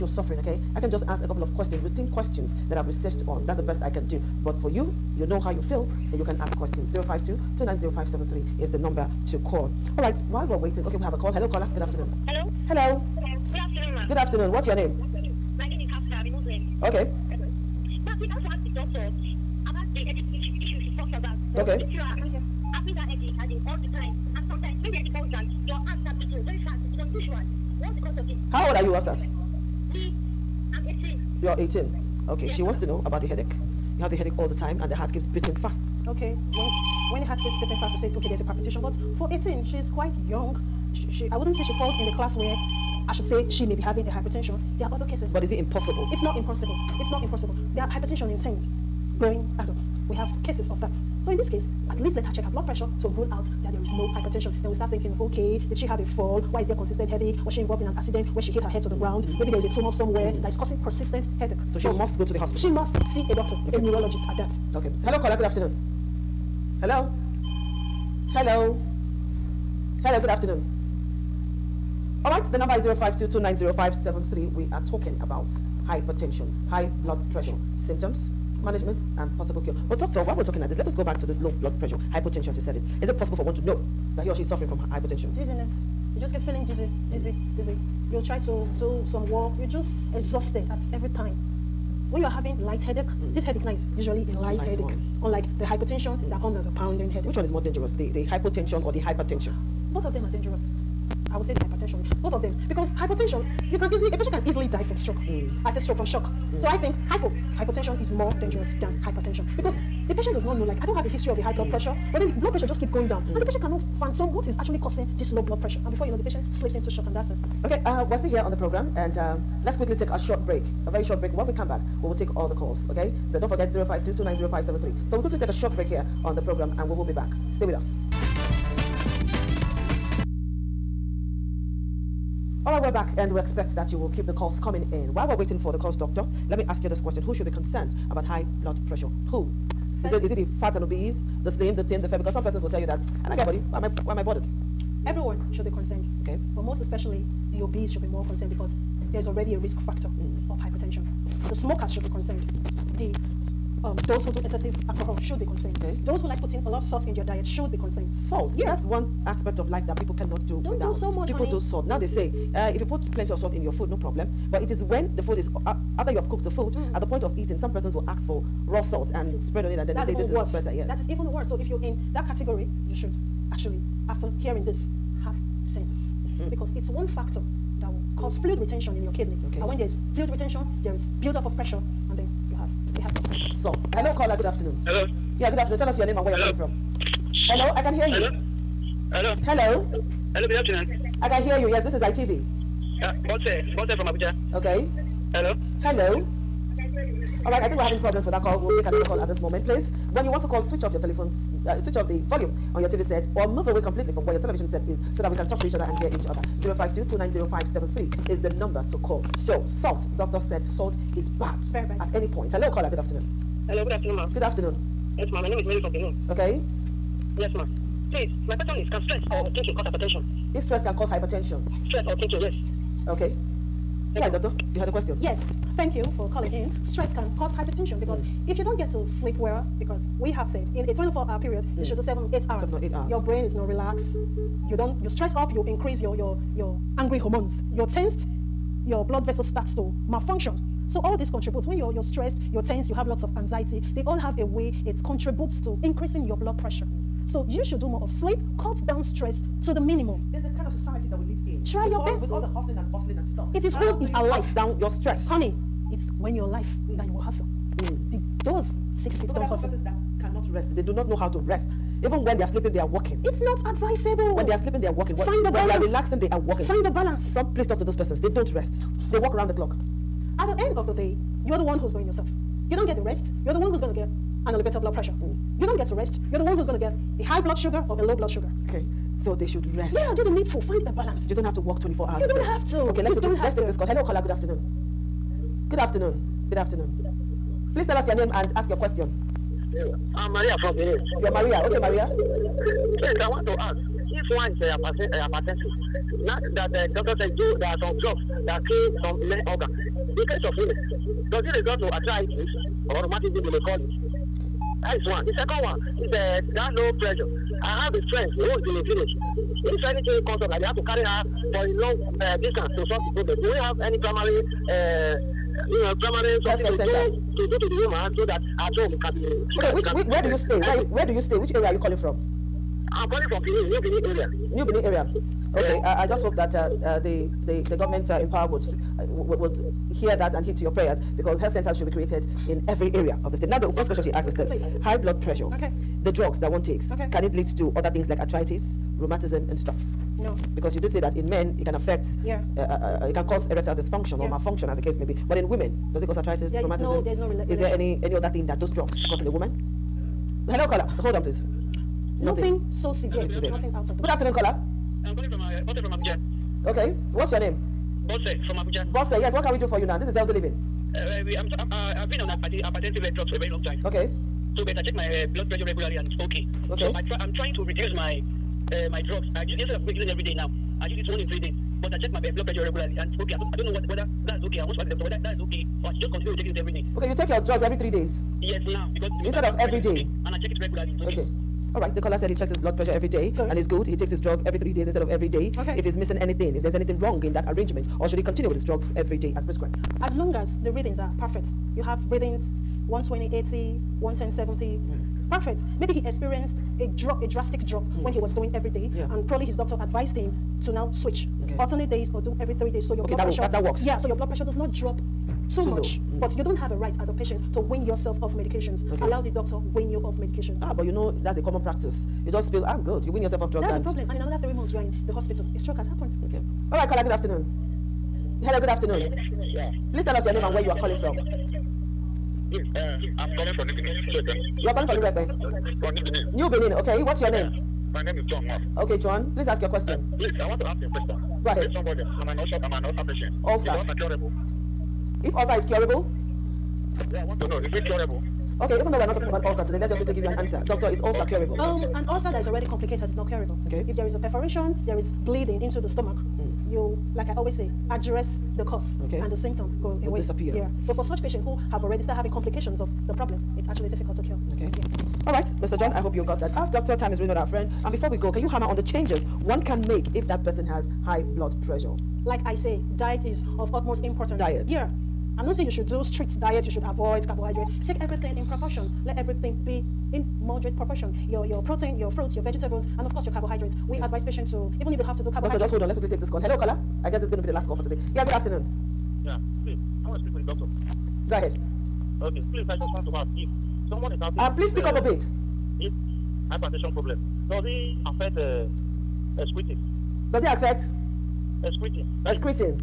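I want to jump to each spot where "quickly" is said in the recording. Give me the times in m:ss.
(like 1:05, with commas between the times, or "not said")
1:59, 2:05, 7:19, 7:55.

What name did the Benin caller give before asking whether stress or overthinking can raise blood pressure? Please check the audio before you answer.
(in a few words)
Mary.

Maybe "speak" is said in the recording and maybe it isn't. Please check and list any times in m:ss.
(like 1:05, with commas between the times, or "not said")
8:00, 8:04.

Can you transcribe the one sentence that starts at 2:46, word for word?
at the point of eating, some persons will ask for raw salt and spread on it and then they say this worse.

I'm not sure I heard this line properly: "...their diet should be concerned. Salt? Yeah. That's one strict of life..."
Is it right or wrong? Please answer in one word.
wrong.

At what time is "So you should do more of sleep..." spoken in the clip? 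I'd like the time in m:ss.
4:07.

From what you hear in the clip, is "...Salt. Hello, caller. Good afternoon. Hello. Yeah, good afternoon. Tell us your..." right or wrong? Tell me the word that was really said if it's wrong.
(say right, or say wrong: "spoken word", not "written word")
right.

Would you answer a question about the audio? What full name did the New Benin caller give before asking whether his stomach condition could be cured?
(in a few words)
John Mark.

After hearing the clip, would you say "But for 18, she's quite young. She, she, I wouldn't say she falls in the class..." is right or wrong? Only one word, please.
right.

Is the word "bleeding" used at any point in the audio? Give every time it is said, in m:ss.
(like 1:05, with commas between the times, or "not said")
7:25.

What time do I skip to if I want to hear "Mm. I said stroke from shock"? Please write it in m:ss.
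1:45.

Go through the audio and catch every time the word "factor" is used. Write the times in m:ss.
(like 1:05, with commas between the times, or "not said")
2:29, 2:57.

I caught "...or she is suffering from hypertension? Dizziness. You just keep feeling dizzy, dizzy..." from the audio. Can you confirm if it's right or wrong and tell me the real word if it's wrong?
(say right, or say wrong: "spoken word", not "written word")
right.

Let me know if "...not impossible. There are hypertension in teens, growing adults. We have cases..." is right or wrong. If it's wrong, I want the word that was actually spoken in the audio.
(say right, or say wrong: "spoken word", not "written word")
right.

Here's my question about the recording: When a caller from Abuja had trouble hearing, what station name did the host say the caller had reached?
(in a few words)
ITV.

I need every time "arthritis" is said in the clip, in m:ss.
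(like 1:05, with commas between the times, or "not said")
5:01, 5:38, 5:46.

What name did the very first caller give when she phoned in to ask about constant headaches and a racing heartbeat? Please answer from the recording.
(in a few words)
Hafsa.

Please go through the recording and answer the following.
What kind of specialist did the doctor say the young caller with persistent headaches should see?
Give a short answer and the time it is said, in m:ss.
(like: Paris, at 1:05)
A neurologist, at 1:03.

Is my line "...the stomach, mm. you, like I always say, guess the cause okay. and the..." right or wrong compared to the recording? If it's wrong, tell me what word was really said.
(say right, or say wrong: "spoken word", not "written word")
wrong: "address", not "guess".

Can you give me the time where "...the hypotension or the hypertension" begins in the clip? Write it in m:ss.
1:38.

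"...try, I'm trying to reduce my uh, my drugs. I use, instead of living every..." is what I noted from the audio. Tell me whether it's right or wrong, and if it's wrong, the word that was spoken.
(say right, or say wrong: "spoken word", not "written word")
wrong: "using", not "living".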